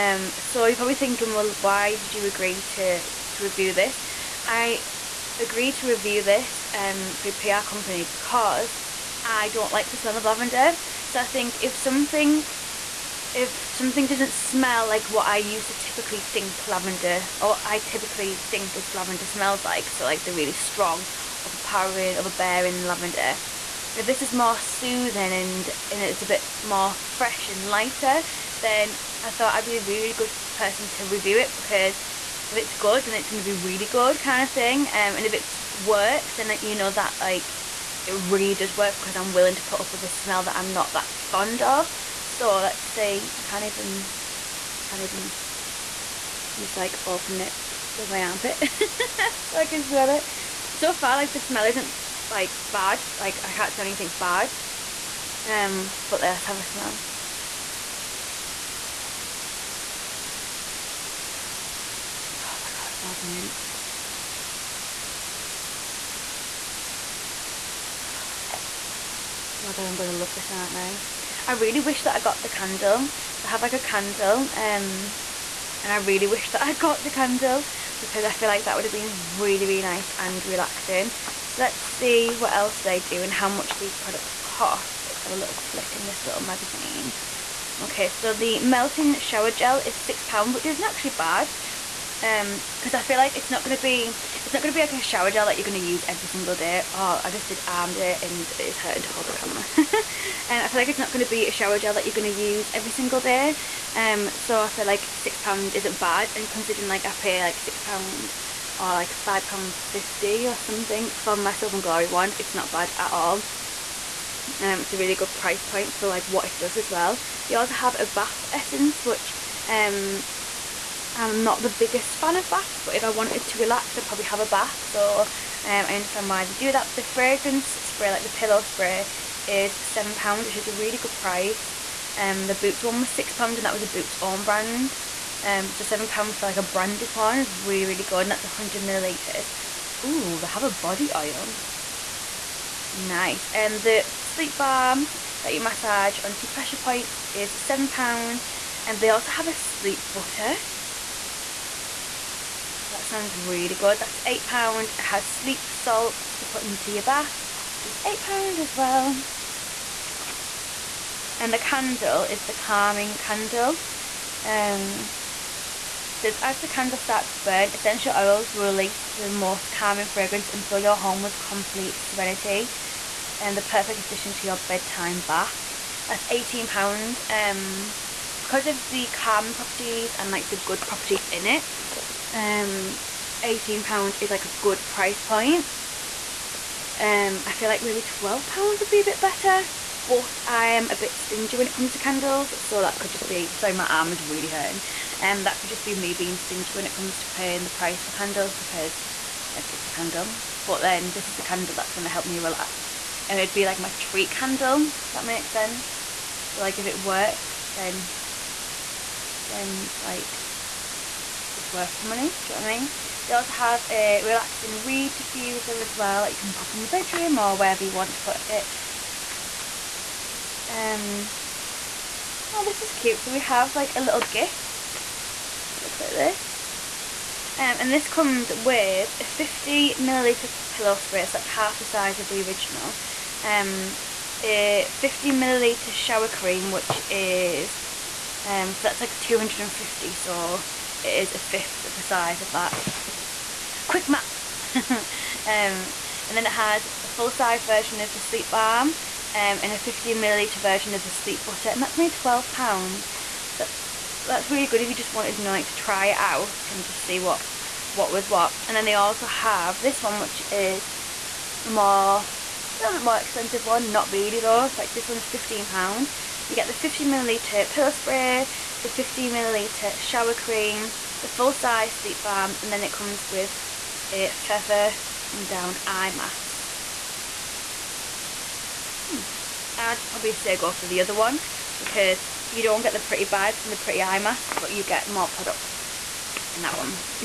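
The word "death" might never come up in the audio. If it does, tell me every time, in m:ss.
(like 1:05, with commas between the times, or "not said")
not said.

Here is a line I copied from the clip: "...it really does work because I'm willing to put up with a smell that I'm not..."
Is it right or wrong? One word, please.
right.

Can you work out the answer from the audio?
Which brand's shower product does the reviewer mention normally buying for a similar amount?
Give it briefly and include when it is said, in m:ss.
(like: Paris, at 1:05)
Soap and Glory, at 1:51.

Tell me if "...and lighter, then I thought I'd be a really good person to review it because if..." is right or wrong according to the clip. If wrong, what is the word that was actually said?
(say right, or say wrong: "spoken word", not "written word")
right.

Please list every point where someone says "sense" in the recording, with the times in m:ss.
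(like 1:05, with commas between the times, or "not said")
3:25.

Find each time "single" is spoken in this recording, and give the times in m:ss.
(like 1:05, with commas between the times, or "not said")
1:36, 1:42.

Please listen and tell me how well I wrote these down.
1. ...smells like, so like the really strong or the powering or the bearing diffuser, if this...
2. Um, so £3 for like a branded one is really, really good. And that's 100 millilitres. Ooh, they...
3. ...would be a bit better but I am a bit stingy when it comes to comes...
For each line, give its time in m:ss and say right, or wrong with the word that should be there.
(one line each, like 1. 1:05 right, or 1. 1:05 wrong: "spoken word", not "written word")
1. 0:19 wrong: "lavender", not "diffuser"
2. 2:15 wrong: "7", not "3"
3. 3:08 wrong: "candles", not "comes".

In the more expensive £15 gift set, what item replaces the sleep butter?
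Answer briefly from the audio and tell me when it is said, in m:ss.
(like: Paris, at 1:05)
feather and down eye mask, at 4:34.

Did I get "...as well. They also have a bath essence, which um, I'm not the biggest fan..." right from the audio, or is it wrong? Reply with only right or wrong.
right.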